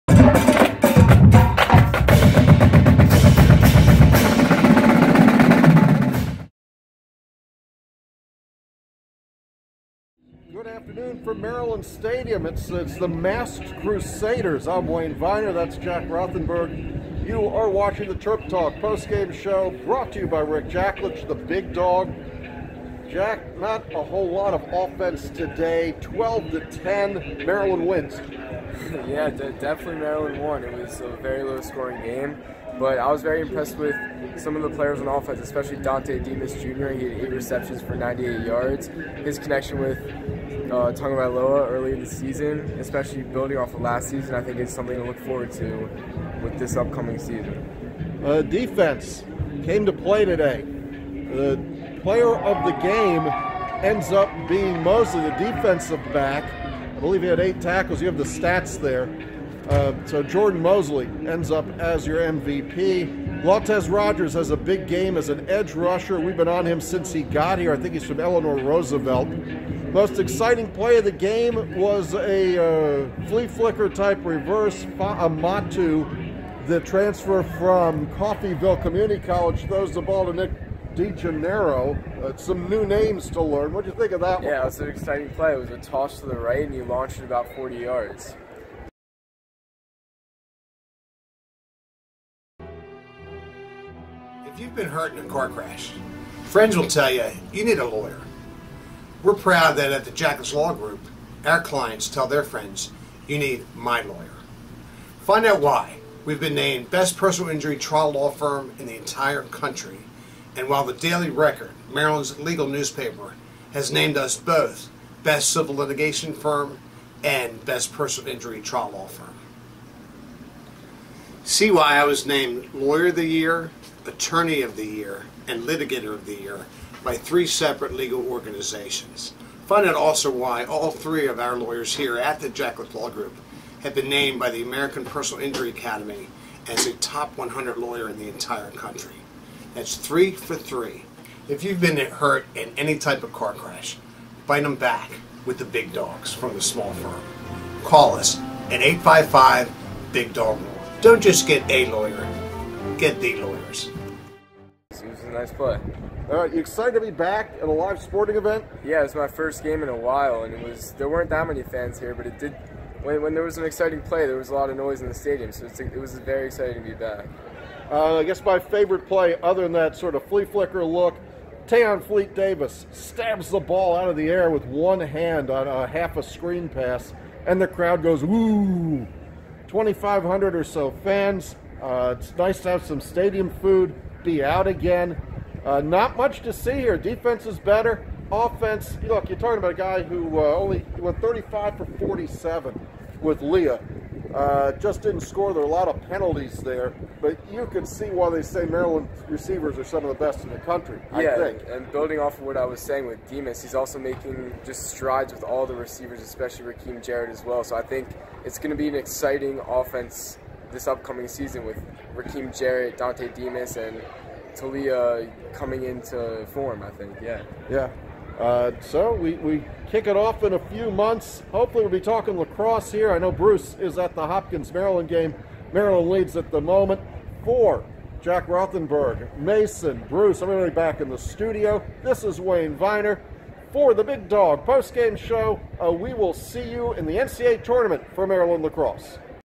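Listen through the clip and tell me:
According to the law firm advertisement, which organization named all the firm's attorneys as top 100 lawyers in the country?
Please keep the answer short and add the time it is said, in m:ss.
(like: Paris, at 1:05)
American Personal Injury Academy, at 2:14.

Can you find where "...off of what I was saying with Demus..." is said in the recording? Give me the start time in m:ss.
3:22.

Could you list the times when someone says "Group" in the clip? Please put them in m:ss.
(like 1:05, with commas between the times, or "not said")
1:40, 2:13.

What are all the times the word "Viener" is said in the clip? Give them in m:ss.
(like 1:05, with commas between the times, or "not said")
0:15, 3:52.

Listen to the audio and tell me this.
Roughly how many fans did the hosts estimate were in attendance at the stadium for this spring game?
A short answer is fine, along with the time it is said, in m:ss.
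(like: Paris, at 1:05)
2,500, at 2:59.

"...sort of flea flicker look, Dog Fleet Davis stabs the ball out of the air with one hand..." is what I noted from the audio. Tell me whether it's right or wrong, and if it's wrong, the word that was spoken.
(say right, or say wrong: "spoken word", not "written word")
wrong: "Tayon", not "Dog".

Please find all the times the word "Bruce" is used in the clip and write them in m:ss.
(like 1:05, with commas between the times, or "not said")
3:43, 3:50.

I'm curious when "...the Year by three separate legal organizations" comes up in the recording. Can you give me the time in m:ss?
2:06.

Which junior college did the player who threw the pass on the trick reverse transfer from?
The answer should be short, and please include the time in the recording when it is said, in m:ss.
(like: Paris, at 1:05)
Coffeyville Community College, at 1:18.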